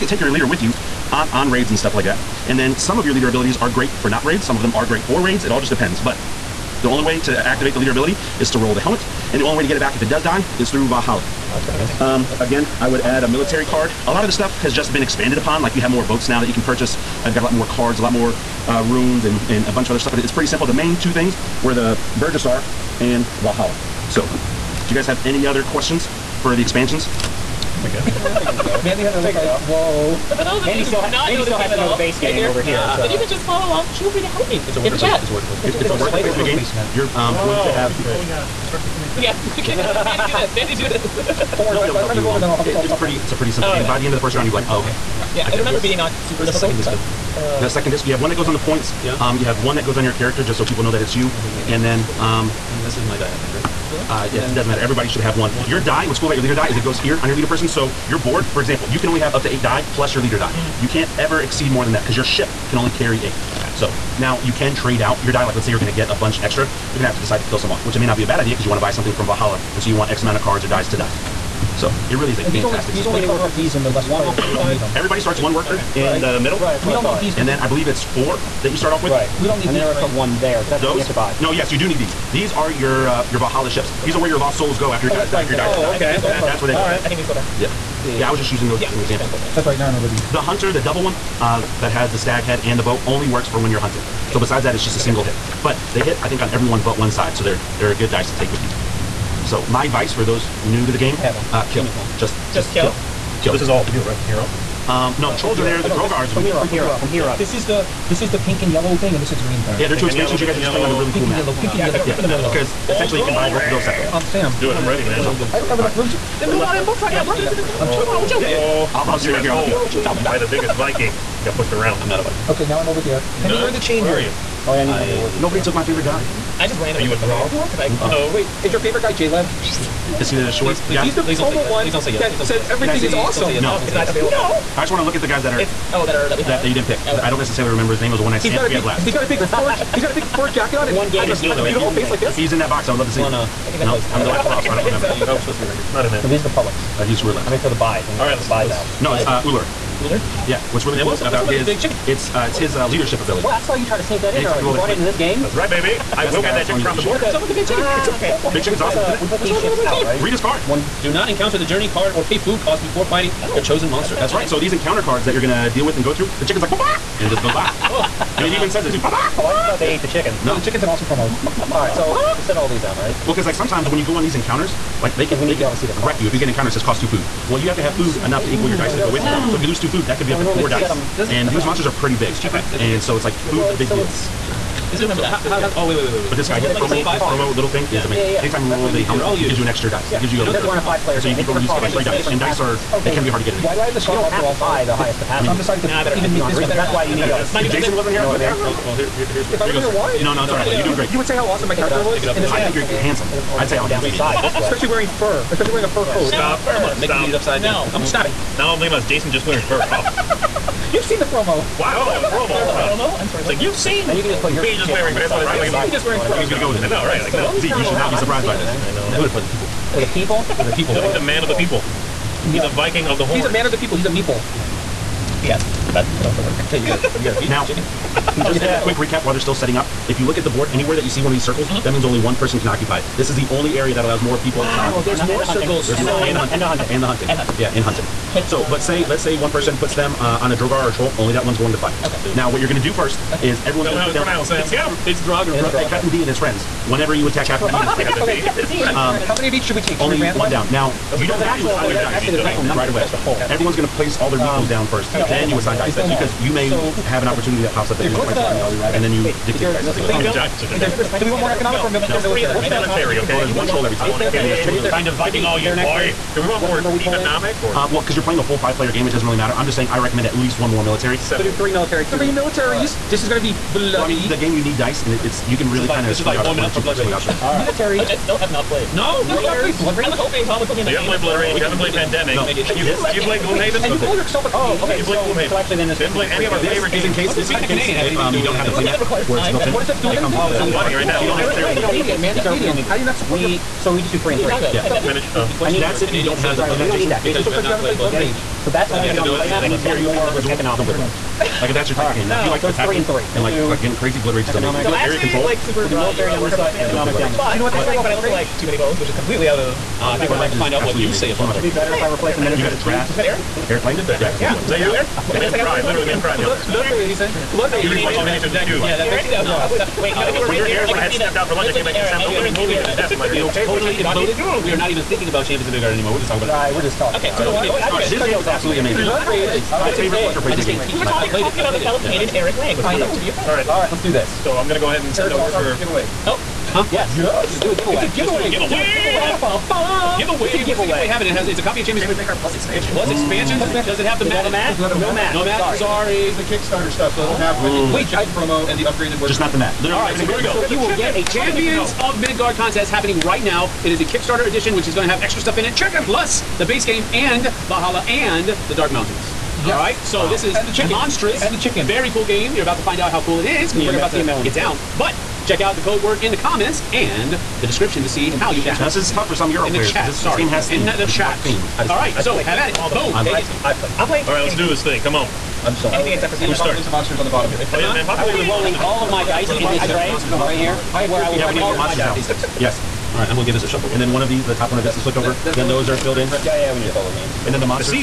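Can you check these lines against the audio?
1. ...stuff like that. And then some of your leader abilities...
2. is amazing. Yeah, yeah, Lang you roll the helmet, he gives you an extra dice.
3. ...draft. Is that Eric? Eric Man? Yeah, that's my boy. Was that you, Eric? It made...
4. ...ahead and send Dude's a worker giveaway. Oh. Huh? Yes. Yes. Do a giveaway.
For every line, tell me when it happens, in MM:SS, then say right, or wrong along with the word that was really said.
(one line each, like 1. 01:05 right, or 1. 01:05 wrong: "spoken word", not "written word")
1. 00:01 right
2. 03:08 wrong: "Anytime", not "Lang"
3. 05:12 wrong: "Langdon", not "Man"
4. 05:34 wrong: "Eric", not "Dude".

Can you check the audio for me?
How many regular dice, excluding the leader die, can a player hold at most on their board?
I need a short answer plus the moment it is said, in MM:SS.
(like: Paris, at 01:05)
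8, at 00:59.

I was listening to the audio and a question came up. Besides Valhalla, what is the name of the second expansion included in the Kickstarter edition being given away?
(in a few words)
The Dark Mountains.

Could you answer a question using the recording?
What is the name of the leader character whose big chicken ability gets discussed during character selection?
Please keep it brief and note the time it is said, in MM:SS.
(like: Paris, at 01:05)
Uller, at 02:29.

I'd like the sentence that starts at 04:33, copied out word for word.
Well, I mean, the game you need dice, and it, it's you can really kind of.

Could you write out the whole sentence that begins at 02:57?
Well, you have to have yeah, food so enough to equal your dice to go with you.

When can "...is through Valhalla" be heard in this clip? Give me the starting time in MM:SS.
00:10.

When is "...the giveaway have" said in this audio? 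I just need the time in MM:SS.
05:40.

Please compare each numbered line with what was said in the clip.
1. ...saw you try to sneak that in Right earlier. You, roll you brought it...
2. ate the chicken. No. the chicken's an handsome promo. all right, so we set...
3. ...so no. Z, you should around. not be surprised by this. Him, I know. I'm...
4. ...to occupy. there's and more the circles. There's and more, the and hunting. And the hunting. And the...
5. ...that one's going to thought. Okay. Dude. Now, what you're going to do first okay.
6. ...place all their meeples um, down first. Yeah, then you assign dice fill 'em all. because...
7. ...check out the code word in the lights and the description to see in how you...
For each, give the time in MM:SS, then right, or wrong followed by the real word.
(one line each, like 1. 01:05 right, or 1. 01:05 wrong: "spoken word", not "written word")
1. 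02:33 wrong: "Anytime", not "Right"
2. 02:49 wrong: "awesome", not "handsome"
3. 03:37 right
4. 03:54 right
5. 04:01 wrong: "fight", not "thought"
6. 04:13 right
7. 06:05 wrong: "comments", not "lights".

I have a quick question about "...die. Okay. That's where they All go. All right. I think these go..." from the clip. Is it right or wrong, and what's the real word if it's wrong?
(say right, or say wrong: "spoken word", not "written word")
right.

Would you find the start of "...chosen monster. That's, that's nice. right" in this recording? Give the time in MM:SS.
02:43.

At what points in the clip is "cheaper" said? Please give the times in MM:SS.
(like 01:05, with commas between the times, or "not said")
03:02.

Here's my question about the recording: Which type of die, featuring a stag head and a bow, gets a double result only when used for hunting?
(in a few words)
The hunter.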